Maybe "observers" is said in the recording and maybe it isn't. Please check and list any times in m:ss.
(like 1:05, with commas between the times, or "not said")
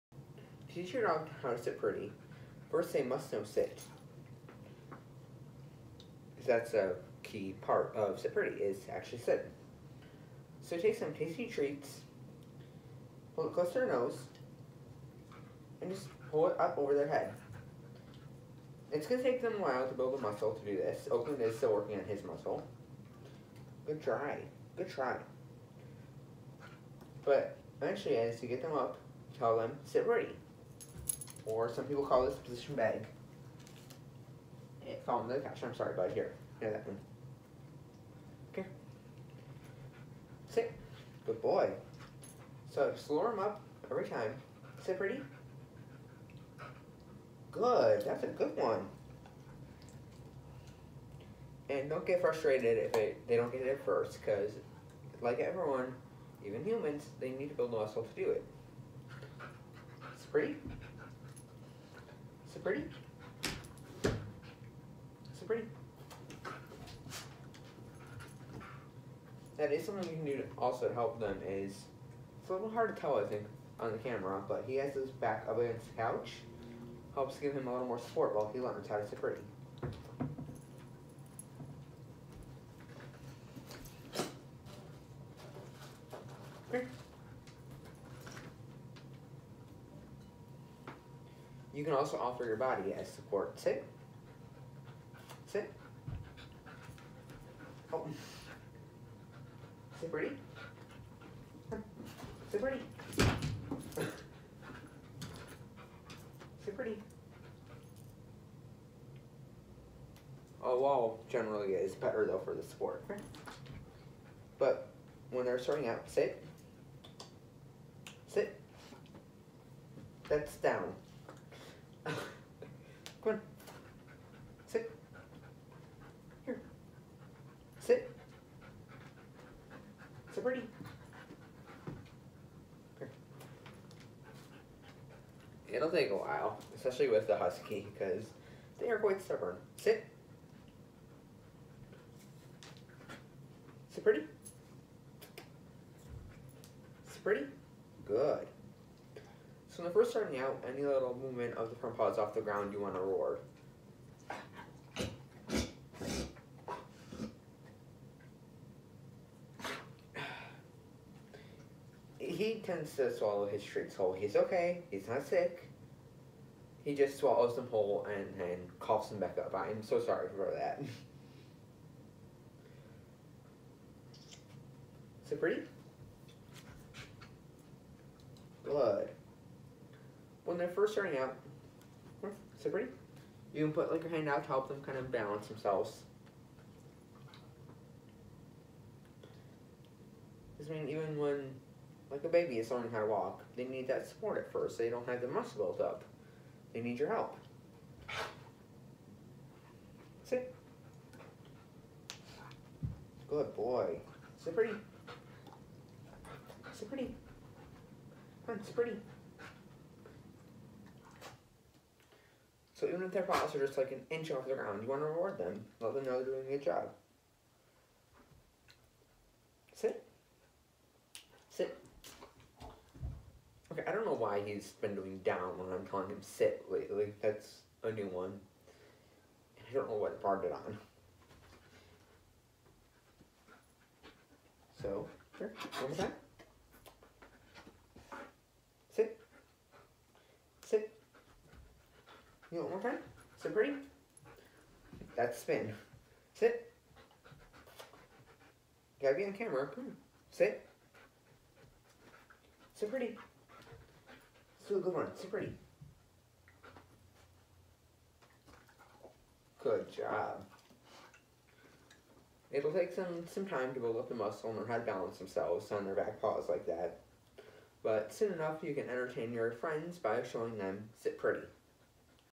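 not said.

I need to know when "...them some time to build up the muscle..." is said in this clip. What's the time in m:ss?
4:22.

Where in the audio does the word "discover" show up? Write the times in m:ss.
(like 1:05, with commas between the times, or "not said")
not said.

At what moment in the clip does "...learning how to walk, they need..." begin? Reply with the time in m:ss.
3:12.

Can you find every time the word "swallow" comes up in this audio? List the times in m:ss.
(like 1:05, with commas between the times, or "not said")
2:43, 2:47.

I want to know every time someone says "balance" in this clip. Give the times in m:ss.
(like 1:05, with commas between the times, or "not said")
3:05, 4:24.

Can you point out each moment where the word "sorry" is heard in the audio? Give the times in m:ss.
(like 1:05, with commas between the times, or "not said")
0:35, 2:49.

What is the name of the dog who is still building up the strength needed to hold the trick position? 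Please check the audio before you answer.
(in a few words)
Oakland.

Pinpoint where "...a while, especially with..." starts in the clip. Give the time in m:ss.
2:16.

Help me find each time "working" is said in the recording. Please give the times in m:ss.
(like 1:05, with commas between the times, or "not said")
0:21.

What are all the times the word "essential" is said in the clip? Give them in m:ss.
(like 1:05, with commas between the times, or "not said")
not said.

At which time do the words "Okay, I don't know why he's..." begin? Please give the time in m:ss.
3:43.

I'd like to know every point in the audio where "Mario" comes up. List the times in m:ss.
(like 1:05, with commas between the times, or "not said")
not said.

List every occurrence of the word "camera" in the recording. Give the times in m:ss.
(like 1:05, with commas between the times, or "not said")
1:13, 4:09.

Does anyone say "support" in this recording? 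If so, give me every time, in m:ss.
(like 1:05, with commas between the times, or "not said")
1:17, 1:33, 1:52, 3:14.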